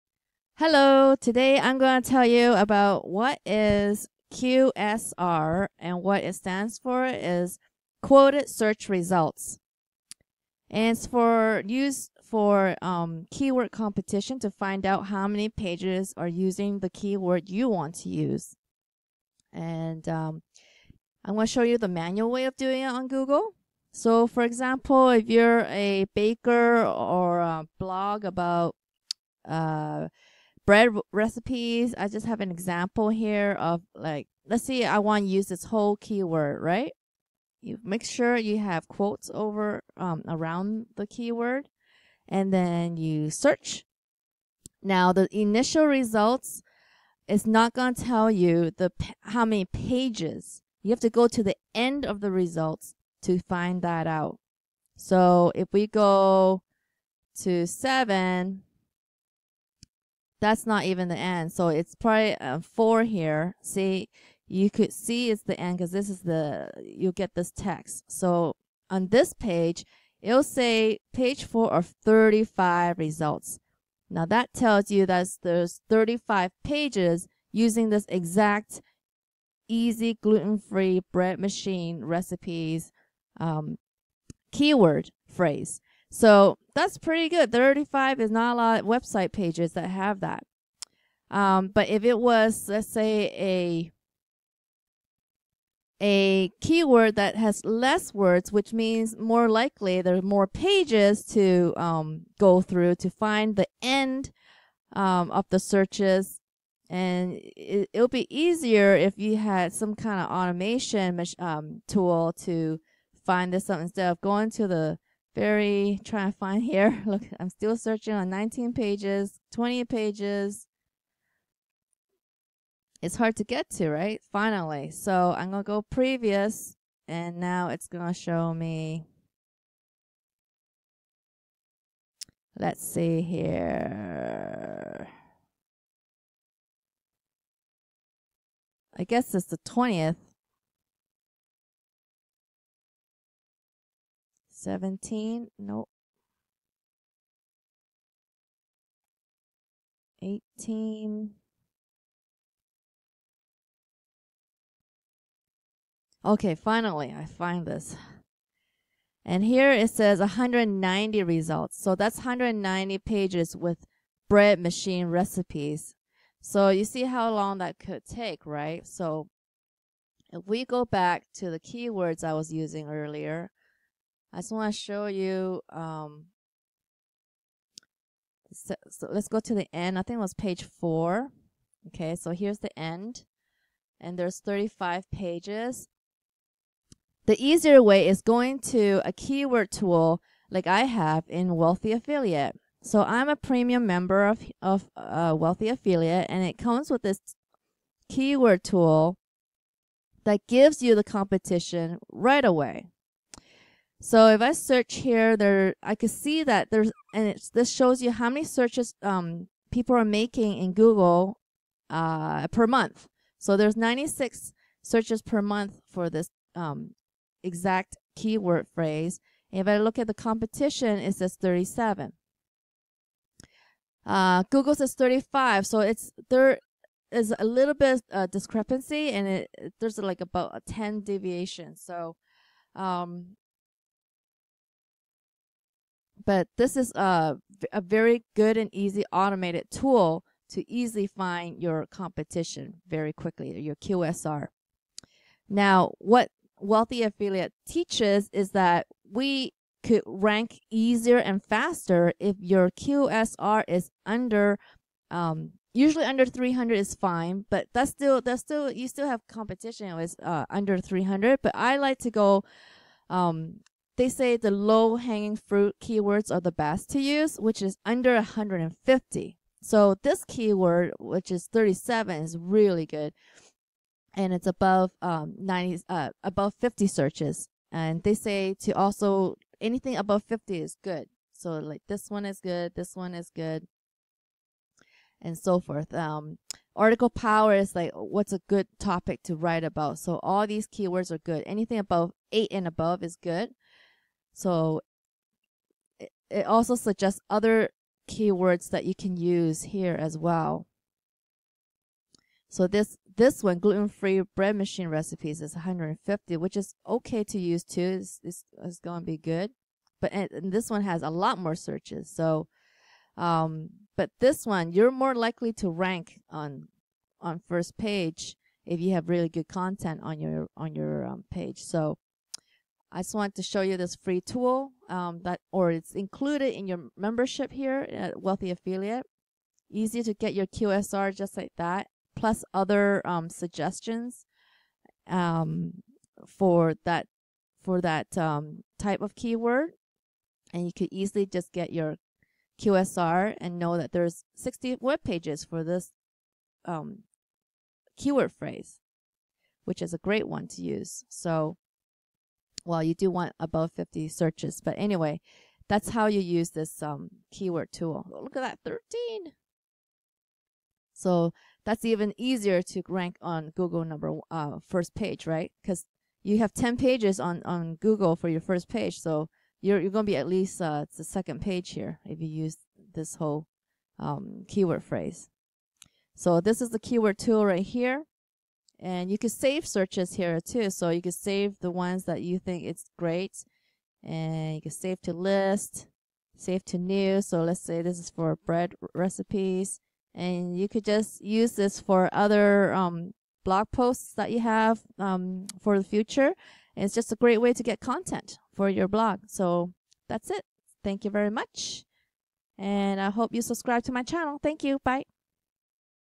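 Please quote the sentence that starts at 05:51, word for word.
So well, you do want above 50 searches.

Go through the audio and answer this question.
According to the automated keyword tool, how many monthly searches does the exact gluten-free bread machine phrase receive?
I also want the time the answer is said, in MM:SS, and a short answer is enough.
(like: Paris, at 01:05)
96, at 03:33.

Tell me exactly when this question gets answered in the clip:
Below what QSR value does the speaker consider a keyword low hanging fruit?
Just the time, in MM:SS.
04:27.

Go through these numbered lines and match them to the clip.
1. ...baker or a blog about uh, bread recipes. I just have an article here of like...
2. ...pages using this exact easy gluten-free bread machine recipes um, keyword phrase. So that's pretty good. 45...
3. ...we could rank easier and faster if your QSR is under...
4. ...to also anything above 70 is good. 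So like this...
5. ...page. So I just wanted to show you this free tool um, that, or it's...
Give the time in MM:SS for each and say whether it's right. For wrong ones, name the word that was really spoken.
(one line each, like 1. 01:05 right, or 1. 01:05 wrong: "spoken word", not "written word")
1. 00:26 wrong: "example", not "article"
2. 01:16 wrong: "35", not "45"
3. 04:09 right
4. 04:38 wrong: "50", not "70"
5. 05:21 right.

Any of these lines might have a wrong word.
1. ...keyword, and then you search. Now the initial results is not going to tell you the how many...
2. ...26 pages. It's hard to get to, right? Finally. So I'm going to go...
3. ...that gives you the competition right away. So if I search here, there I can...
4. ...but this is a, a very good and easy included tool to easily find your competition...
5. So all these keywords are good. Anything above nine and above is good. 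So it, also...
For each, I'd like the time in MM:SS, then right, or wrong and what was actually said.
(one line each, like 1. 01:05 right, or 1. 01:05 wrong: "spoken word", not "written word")
1. 00:41 right
2. 01:59 wrong: "20", not "26"
3. 03:20 right
4. 03:56 wrong: "automated", not "included"
5. 04:49 wrong: "eight", not "nine".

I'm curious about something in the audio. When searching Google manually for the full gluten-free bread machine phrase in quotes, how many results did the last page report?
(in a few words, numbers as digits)
35.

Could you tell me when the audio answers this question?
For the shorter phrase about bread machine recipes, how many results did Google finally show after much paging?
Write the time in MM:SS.
02:40.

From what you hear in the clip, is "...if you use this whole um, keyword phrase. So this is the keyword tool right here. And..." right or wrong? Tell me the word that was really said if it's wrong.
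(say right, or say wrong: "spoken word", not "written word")
right.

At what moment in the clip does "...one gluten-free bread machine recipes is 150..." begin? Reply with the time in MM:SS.
05:03.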